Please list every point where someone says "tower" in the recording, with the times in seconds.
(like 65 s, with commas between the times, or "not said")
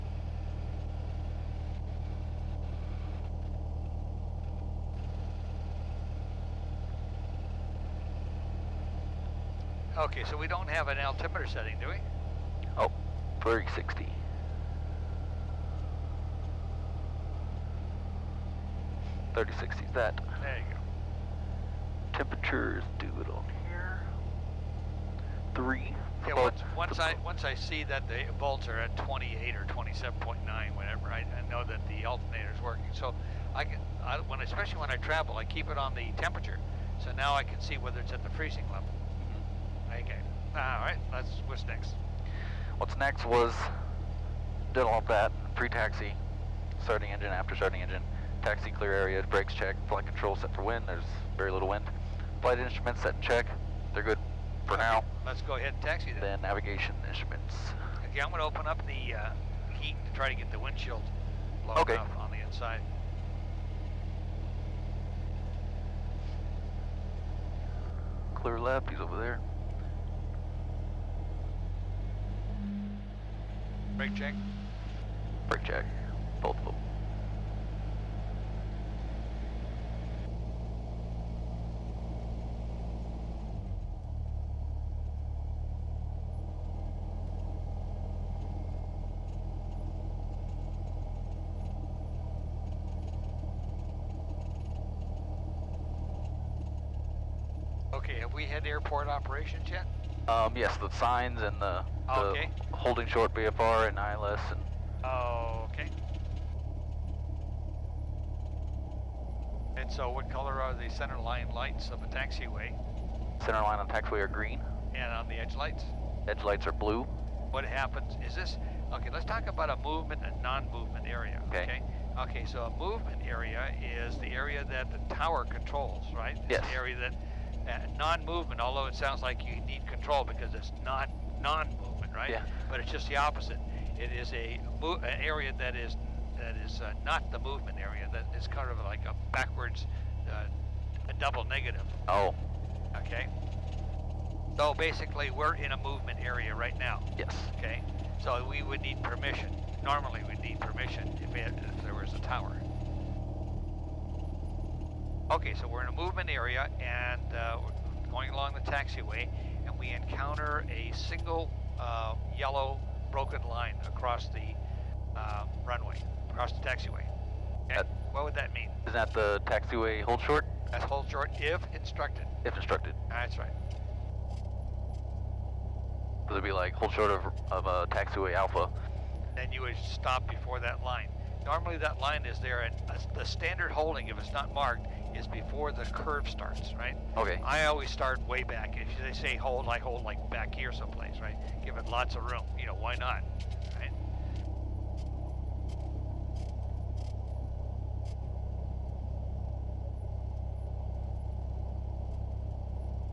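125 s, 152 s.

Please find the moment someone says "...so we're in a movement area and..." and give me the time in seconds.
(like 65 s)
155 s.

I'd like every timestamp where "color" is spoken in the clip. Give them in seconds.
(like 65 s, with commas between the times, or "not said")
110 s.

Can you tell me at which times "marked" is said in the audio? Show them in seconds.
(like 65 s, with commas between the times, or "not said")
184 s.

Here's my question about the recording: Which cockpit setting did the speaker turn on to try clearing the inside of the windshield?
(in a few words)
heat.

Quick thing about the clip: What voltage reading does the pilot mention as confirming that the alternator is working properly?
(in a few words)
28.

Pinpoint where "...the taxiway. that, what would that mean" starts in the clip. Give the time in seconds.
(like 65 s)
166 s.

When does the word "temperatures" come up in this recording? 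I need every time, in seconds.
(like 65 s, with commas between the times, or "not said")
22 s, 36 s.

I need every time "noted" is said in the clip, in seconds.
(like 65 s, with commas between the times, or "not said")
not said.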